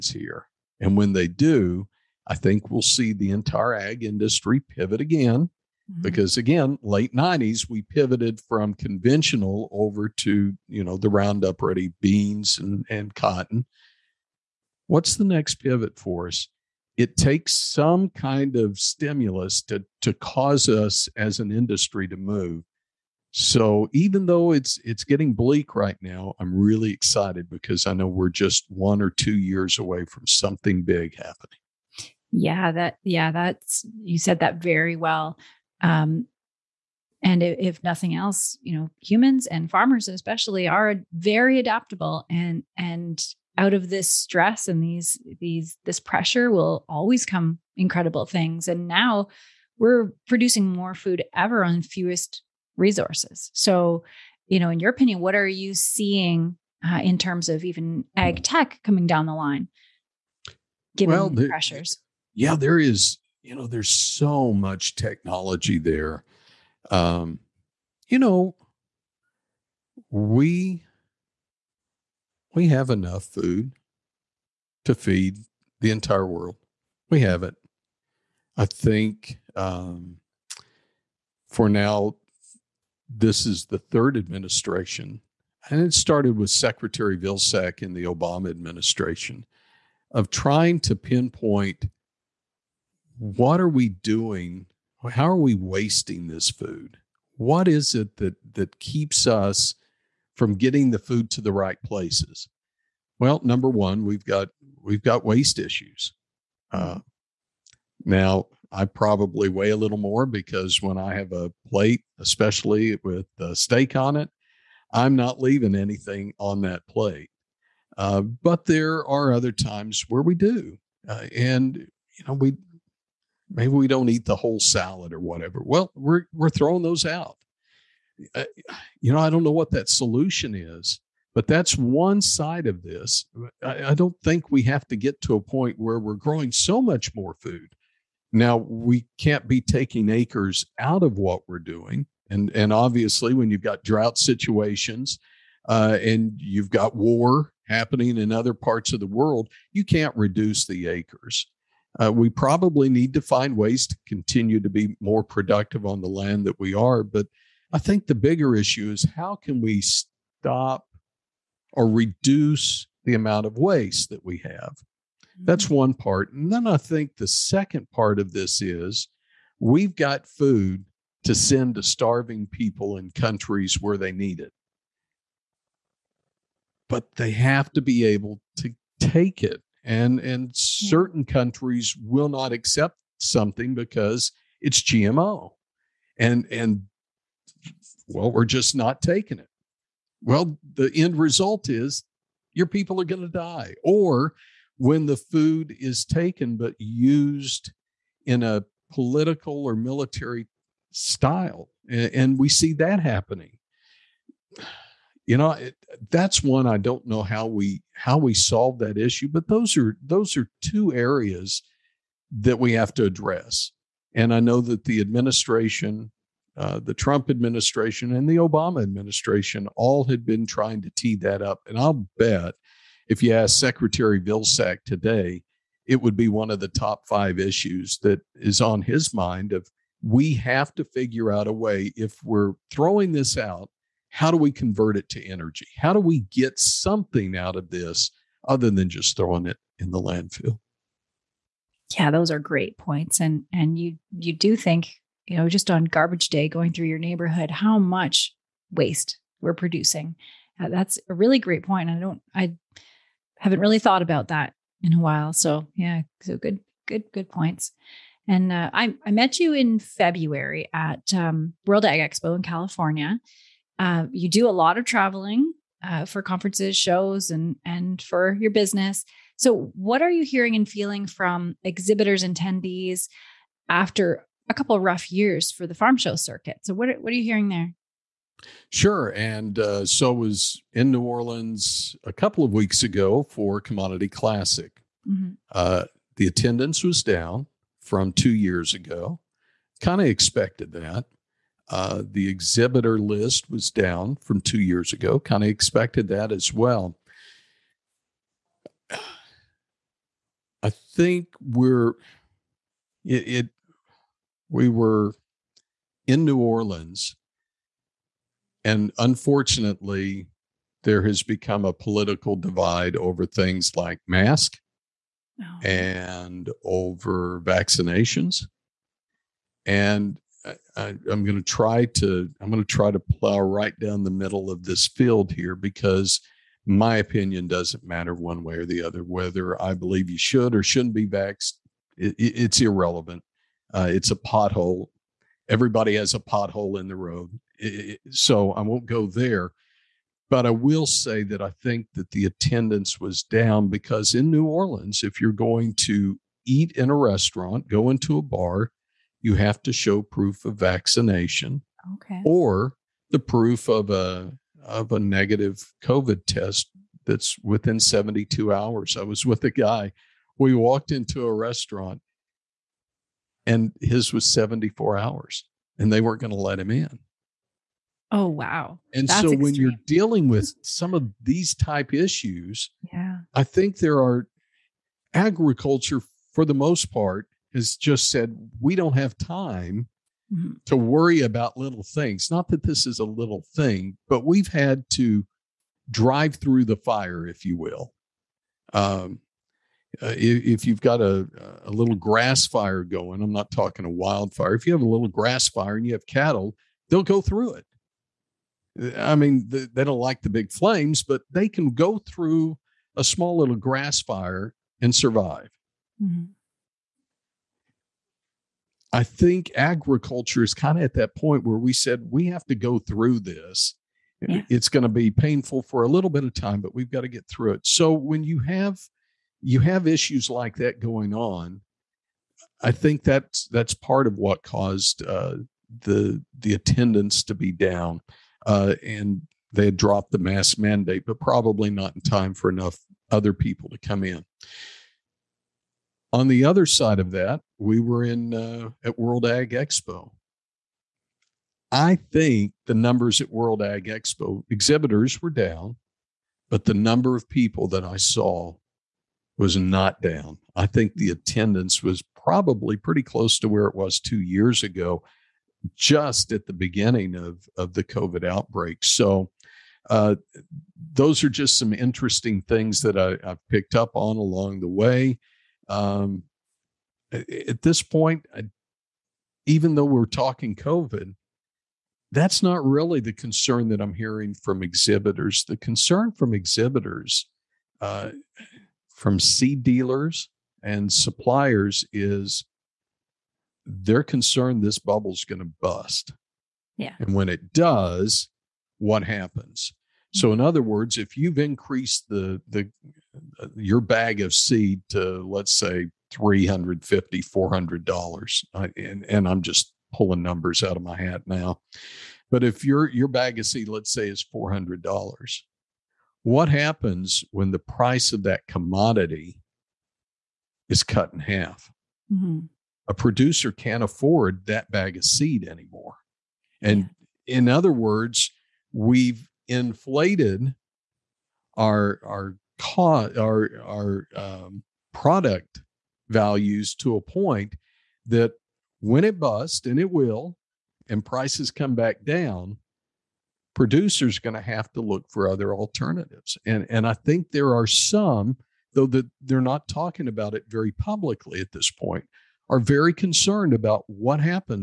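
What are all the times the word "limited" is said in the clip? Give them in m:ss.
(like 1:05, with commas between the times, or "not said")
not said.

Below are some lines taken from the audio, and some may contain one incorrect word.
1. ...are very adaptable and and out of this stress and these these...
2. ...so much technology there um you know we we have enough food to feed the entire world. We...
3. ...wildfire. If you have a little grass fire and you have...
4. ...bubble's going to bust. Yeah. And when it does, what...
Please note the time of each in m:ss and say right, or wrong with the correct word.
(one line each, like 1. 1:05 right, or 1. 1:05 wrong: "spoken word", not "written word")
1. 0:40 right
2. 1:03 right
3. 6:33 right
4. 8:04 right.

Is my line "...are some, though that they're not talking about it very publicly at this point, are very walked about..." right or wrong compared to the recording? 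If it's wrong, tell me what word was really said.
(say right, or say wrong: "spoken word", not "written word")
wrong: "concerned", not "walked".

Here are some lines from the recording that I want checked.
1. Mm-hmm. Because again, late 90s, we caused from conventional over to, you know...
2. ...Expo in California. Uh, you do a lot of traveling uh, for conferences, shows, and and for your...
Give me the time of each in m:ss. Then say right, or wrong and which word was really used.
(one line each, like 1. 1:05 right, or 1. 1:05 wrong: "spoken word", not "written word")
1. 0:05 wrong: "pivoted", not "caused"
2. 4:22 right.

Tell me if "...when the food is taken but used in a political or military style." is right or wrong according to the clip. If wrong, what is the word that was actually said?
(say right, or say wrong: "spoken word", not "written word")
right.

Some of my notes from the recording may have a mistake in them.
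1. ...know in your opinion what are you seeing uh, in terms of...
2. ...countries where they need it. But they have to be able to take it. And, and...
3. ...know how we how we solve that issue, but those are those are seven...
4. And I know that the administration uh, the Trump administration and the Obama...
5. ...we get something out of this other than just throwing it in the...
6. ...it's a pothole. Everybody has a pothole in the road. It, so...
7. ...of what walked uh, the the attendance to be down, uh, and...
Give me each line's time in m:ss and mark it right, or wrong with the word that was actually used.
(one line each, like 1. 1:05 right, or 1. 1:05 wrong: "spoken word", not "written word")
1. 0:54 right
2. 2:53 right
3. 3:27 wrong: "two", not "seven"
4. 3:34 right
5. 3:55 right
6. 5:33 right
7. 7:04 wrong: "caused", not "walked".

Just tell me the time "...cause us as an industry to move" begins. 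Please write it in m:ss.
0:20.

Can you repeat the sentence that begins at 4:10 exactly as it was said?
Uh, that's a really great point.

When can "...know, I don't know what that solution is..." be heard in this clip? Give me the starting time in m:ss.
2:09.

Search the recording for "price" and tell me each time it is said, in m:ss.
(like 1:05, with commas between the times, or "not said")
8:27, 8:51.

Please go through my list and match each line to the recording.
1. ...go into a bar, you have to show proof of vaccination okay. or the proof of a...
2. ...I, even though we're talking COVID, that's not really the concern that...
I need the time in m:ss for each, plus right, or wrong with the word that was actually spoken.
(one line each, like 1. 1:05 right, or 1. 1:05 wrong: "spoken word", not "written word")
1. 5:47 right
2. 7:48 right.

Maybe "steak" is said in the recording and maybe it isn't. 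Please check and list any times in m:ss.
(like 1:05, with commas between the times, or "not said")
1:53.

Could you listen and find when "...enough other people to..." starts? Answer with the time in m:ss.
7:12.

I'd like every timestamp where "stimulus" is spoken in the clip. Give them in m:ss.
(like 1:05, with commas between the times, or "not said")
0:18.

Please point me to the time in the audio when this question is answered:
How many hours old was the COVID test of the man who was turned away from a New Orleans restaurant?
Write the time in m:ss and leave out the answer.
6:04.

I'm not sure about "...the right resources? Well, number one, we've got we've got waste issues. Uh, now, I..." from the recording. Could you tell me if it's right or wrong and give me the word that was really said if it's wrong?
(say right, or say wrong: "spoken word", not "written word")
wrong: "places", not "resources".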